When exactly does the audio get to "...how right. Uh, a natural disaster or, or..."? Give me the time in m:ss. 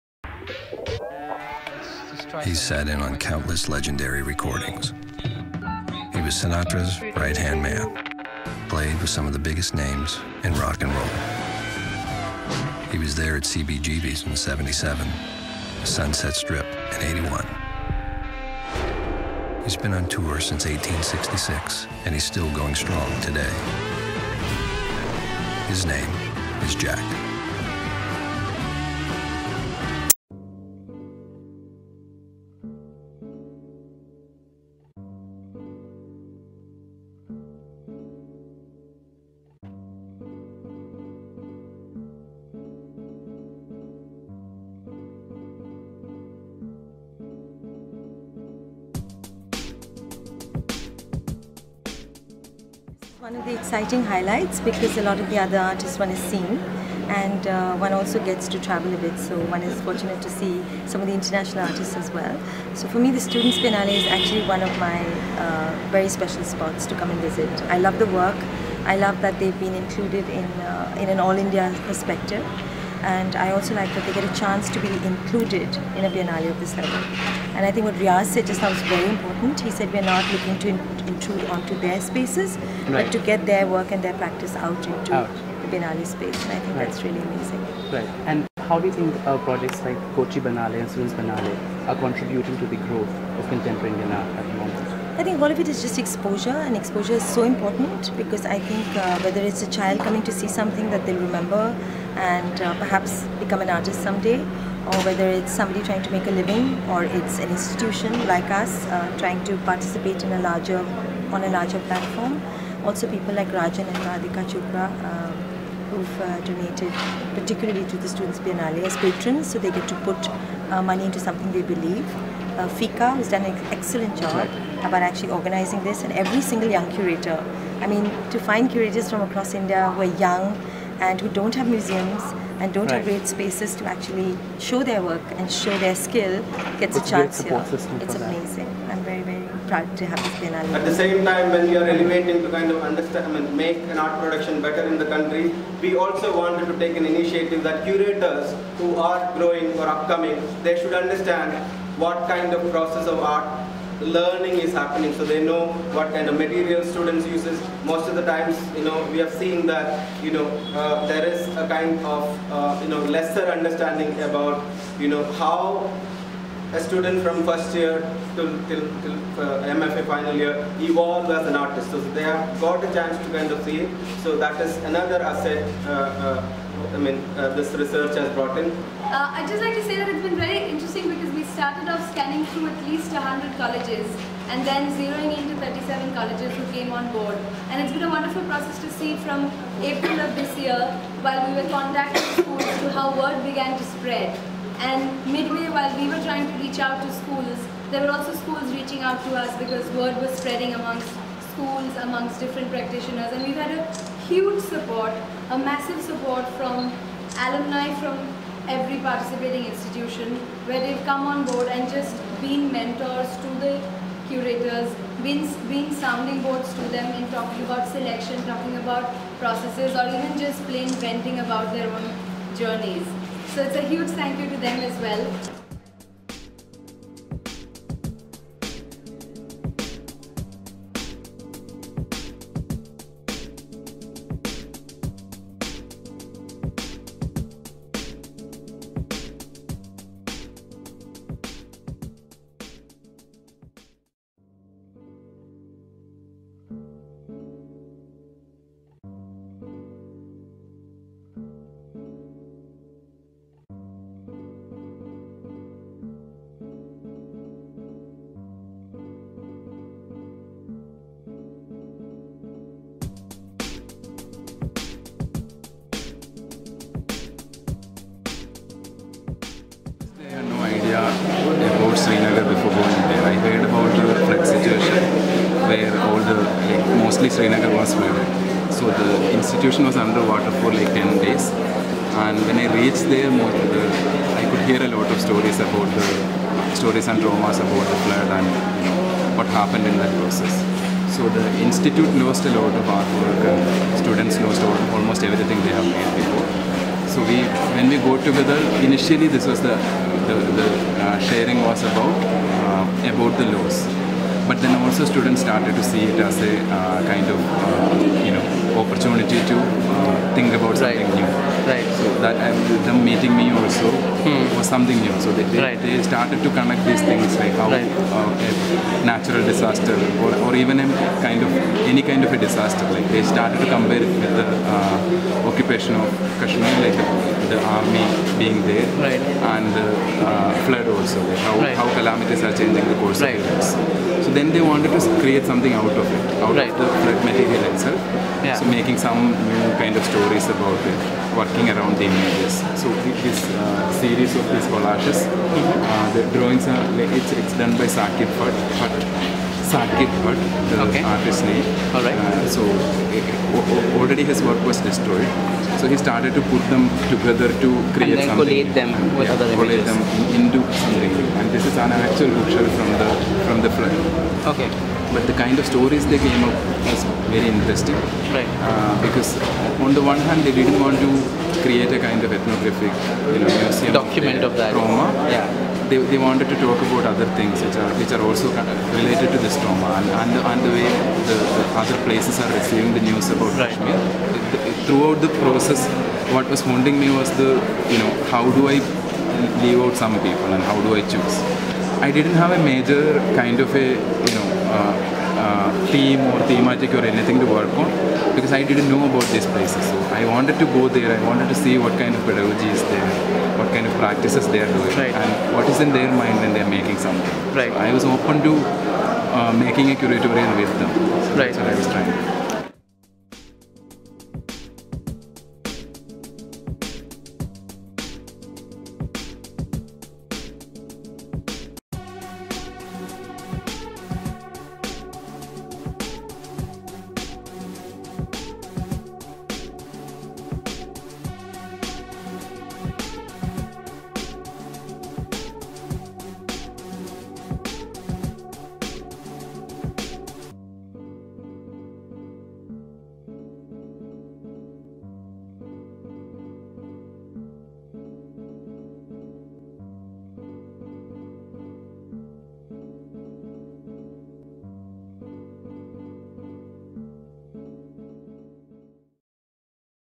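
5:17.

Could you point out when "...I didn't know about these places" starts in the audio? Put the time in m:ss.
6:38.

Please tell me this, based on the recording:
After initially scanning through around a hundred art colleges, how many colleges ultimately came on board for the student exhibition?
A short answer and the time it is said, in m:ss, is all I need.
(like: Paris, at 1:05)
37, at 3:05.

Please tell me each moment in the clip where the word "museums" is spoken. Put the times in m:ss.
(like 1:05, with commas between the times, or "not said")
2:11, 6:13.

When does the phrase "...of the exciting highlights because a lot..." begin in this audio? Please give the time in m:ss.
0:53.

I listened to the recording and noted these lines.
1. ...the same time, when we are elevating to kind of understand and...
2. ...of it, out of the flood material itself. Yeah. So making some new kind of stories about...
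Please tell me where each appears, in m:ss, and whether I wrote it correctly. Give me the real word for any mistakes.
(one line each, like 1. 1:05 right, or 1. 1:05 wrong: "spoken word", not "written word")
1. 2:20 right
2. 5:35 right.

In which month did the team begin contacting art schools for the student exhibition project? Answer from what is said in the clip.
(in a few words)
April.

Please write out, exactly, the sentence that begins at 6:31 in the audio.
I didn't have a major kind of a you know.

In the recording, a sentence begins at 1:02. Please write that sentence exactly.
So for me the Students Biennale is actually one of my uh, very special spots to come and visit.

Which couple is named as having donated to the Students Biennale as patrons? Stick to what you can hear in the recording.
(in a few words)
Rajan and Radhika Chopra.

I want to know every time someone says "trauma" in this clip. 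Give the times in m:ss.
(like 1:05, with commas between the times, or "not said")
4:47, 6:14, 6:19.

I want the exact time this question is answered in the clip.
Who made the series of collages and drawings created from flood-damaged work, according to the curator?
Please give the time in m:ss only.
5:47.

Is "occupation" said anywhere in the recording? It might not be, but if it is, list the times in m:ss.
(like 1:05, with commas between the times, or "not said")
5:25.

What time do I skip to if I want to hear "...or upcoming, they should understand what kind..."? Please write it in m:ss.
2:29.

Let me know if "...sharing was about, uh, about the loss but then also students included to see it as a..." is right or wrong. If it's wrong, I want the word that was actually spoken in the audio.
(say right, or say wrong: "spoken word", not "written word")
wrong: "started", not "included".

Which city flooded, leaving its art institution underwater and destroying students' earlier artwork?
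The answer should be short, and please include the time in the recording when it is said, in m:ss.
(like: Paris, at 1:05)
Srinagar, at 4:37.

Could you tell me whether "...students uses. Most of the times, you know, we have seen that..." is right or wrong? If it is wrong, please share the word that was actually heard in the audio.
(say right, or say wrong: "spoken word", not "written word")
right.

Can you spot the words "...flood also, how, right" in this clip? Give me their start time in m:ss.
5:30.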